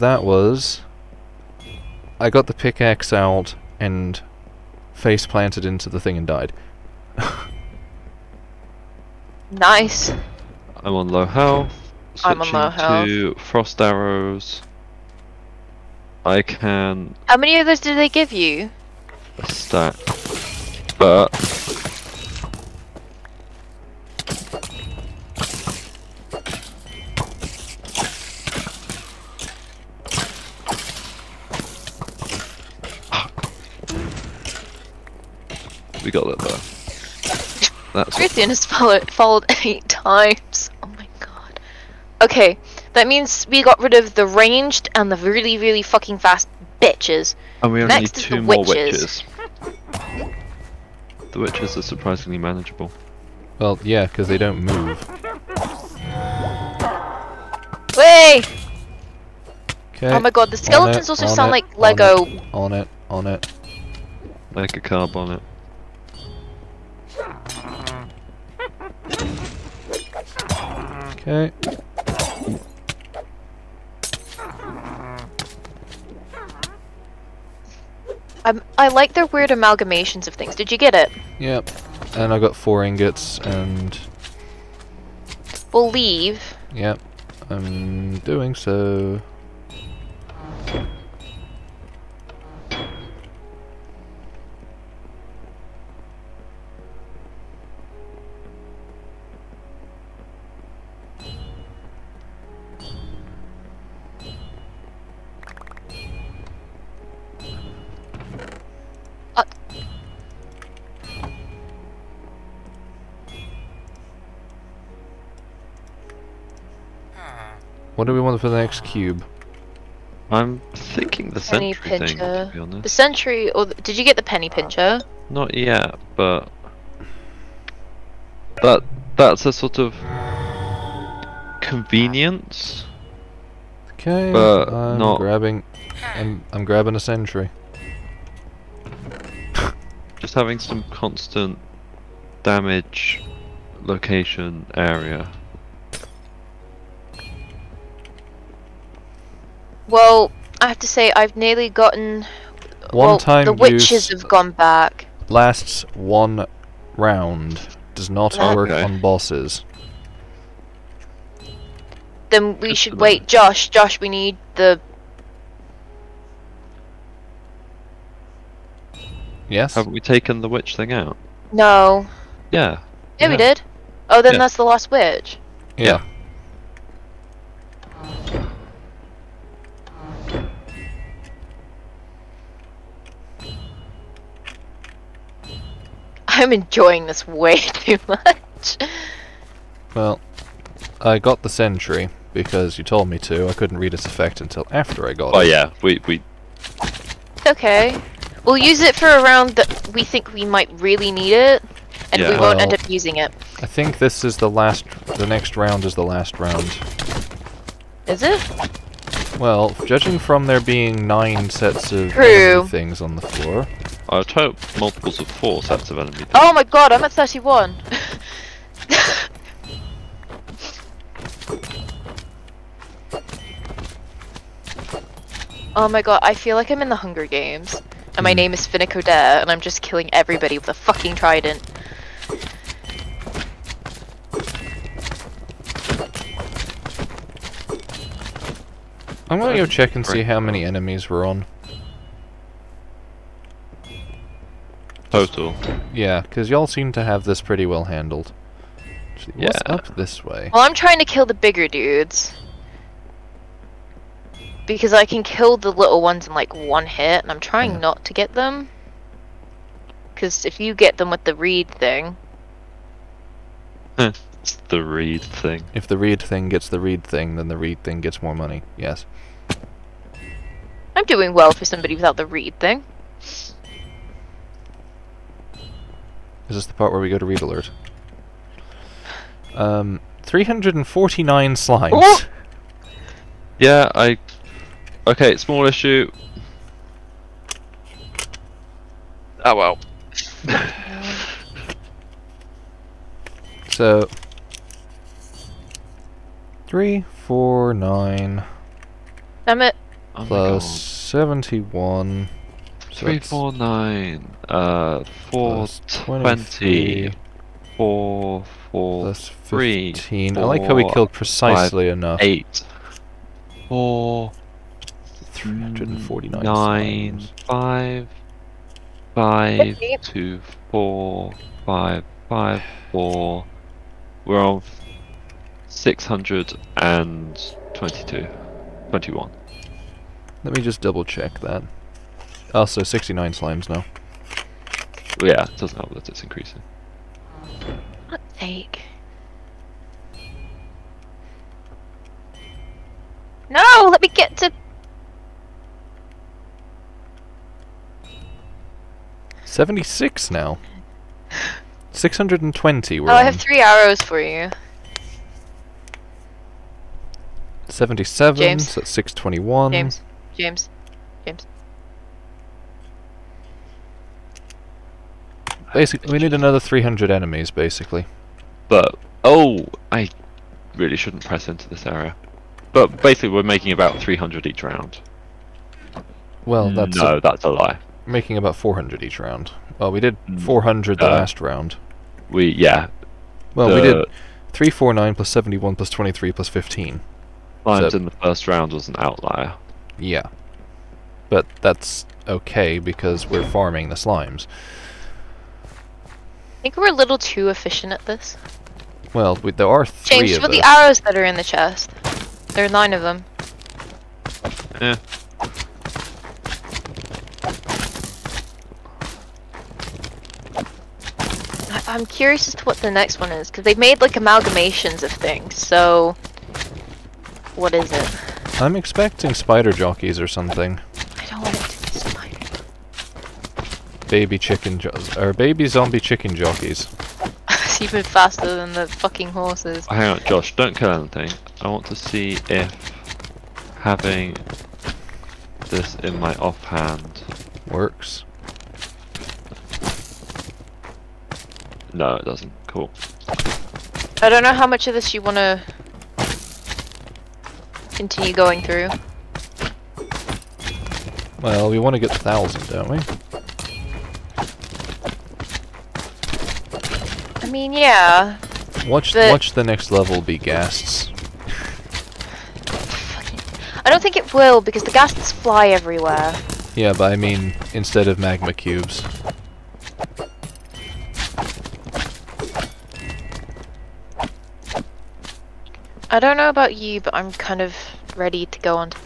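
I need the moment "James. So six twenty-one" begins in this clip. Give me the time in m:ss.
5:58.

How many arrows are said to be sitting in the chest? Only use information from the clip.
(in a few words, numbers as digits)
9.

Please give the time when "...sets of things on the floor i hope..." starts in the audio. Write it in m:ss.
3:31.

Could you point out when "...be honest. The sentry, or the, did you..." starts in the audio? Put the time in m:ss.
2:02.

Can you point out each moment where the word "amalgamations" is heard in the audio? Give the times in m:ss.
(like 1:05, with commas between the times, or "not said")
1:19, 6:54.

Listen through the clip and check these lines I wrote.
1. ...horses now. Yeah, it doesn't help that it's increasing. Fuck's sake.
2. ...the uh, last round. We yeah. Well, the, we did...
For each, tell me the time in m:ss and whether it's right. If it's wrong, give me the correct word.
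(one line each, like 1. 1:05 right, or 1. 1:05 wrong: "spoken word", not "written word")
1. 5:33 wrong: "slimes", not "horses"
2. 6:20 right.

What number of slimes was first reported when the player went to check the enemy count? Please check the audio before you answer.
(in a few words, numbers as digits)
349.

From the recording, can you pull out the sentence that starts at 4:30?
I'm doing well for somebody without the reed thing.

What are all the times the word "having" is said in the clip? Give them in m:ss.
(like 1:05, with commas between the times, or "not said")
2:20, 7:13.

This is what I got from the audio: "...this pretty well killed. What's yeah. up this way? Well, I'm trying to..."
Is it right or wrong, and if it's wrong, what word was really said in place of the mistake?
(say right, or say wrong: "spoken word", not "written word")
wrong: "handled", not "killed".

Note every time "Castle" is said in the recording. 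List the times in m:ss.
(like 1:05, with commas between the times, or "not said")
not said.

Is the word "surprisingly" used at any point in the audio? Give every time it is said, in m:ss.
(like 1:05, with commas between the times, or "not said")
0:51.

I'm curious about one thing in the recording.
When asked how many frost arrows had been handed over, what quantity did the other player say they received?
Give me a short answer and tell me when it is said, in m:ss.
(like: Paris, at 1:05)
A stack, at 0:19.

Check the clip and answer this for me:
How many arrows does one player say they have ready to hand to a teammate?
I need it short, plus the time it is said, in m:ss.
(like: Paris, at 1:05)
3, at 5:53.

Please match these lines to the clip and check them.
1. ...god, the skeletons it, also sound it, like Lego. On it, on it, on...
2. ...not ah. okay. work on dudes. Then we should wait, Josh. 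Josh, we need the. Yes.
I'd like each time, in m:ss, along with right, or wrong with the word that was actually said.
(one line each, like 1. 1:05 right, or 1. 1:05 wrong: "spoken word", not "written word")
1. 1:00 right
2. 2:38 wrong: "bosses", not "dudes".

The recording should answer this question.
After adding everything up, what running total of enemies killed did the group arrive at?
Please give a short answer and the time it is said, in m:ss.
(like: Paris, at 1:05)
622, at 5:25.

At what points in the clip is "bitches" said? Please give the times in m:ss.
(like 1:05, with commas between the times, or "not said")
0:46.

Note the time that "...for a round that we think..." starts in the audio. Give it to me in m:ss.
3:18.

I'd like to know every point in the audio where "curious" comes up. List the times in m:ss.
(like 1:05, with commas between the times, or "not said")
6:52.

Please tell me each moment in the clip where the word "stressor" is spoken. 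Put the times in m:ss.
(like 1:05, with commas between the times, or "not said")
not said.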